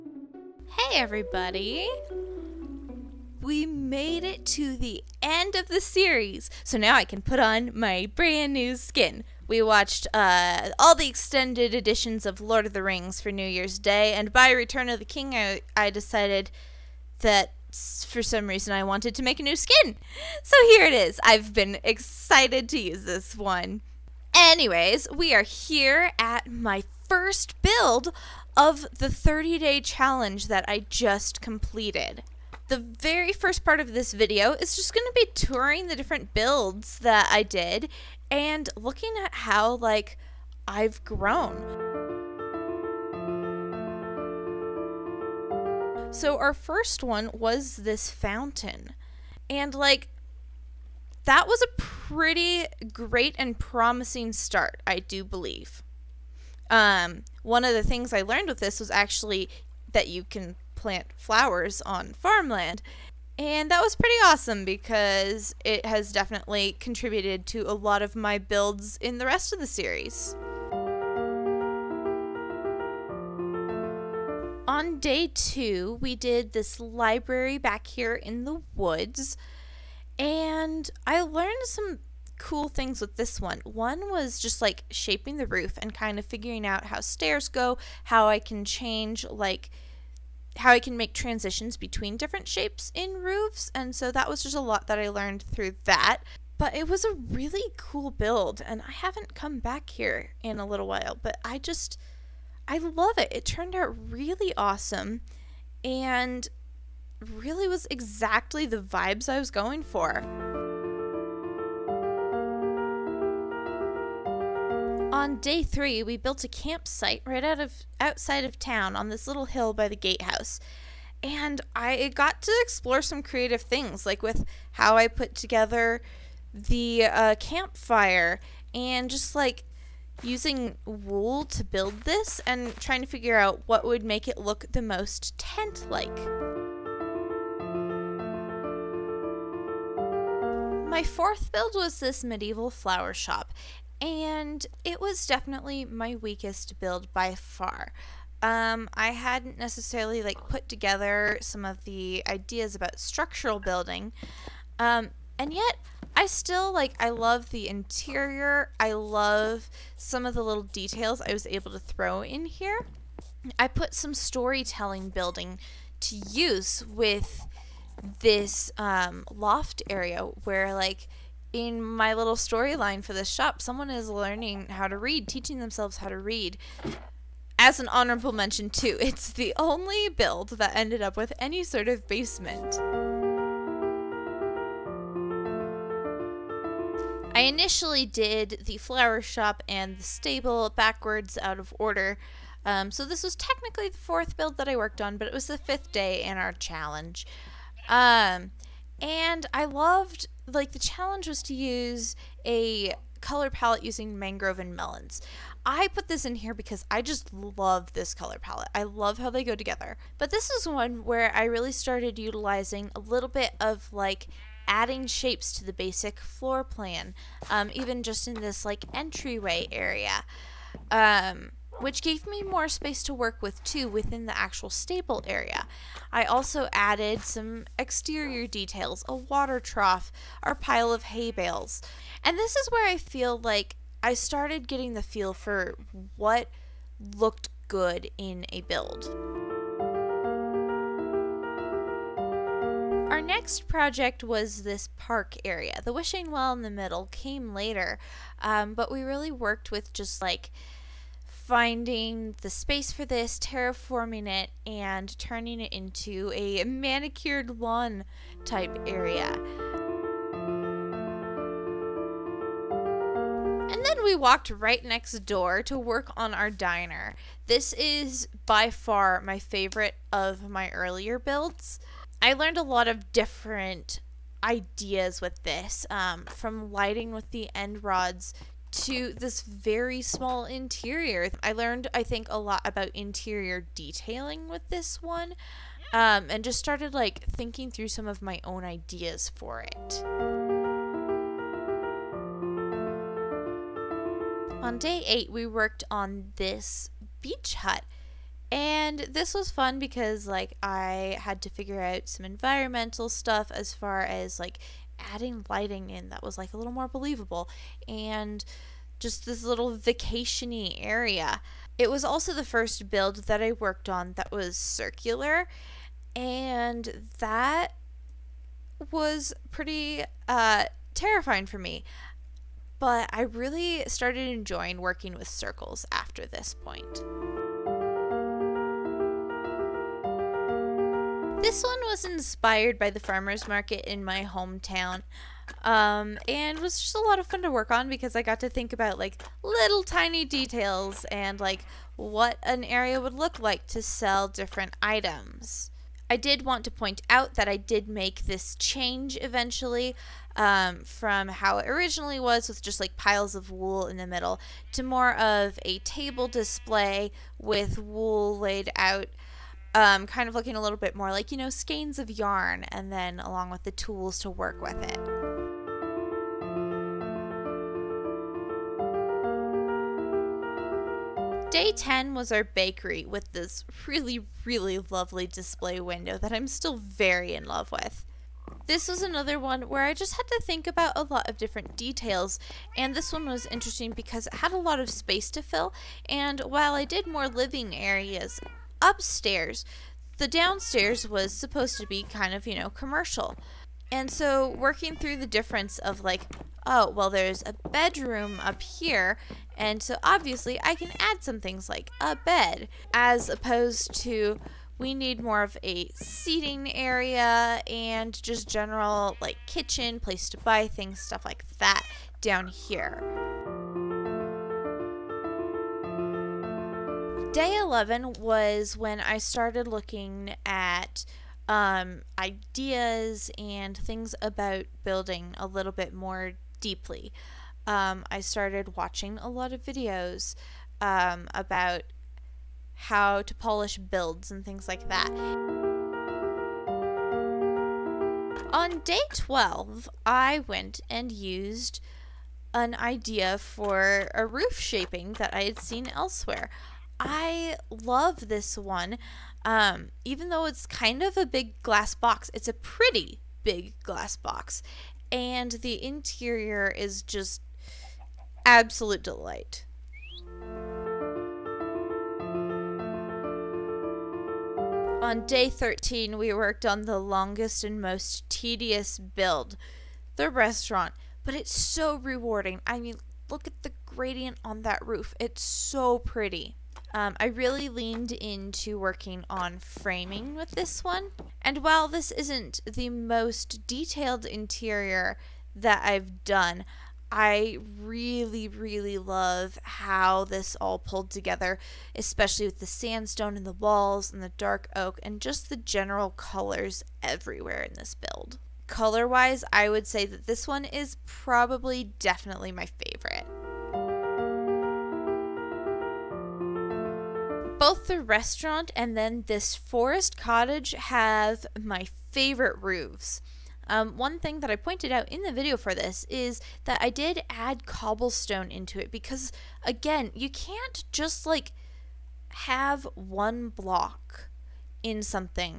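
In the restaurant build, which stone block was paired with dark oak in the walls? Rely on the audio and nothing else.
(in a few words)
sandstone.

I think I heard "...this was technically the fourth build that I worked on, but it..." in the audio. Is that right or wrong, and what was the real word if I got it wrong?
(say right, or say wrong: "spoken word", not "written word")
right.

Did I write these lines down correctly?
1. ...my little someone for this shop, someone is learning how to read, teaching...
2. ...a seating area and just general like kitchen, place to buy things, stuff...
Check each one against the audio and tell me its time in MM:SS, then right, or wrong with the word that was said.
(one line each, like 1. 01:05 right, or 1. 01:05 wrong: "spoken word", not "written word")
1. 02:51 wrong: "storyline", not "someone"
2. 06:45 right.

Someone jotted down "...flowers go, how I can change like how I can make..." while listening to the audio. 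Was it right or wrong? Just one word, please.
wrong.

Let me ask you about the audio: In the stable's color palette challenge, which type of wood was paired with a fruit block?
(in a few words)
mangrove.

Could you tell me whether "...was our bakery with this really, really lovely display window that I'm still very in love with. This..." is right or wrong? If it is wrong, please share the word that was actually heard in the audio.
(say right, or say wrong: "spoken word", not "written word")
right.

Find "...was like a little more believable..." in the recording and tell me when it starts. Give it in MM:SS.
05:06.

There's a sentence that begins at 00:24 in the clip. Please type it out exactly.
Anyways, we are here at my first build of the 30 day challenge that I just completed.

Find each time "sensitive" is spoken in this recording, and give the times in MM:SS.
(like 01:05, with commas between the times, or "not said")
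not said.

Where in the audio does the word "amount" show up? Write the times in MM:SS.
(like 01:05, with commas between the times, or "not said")
not said.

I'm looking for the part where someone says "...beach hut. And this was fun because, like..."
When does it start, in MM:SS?
04:57.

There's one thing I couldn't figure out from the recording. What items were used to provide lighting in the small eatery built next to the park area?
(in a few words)
end rods.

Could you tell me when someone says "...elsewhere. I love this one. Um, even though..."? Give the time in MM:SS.
07:25.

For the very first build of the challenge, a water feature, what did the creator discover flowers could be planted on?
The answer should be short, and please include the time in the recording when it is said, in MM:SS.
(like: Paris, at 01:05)
farmland, at 01:02.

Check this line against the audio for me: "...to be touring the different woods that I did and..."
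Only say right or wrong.
wrong.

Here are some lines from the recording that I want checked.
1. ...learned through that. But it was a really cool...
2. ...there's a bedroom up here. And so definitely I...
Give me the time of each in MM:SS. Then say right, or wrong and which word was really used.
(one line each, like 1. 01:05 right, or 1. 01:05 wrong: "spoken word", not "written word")
1. 01:35 right
2. 06:37 wrong: "obviously", not "definitely".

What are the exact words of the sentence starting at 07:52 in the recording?
I mean, look at the gradient on that roof.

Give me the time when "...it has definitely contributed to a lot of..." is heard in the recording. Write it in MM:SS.
01:05.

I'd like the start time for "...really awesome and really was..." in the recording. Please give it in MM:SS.
01:44.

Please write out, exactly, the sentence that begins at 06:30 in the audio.
The downstairs was supposed to be kind of, you know, commercial.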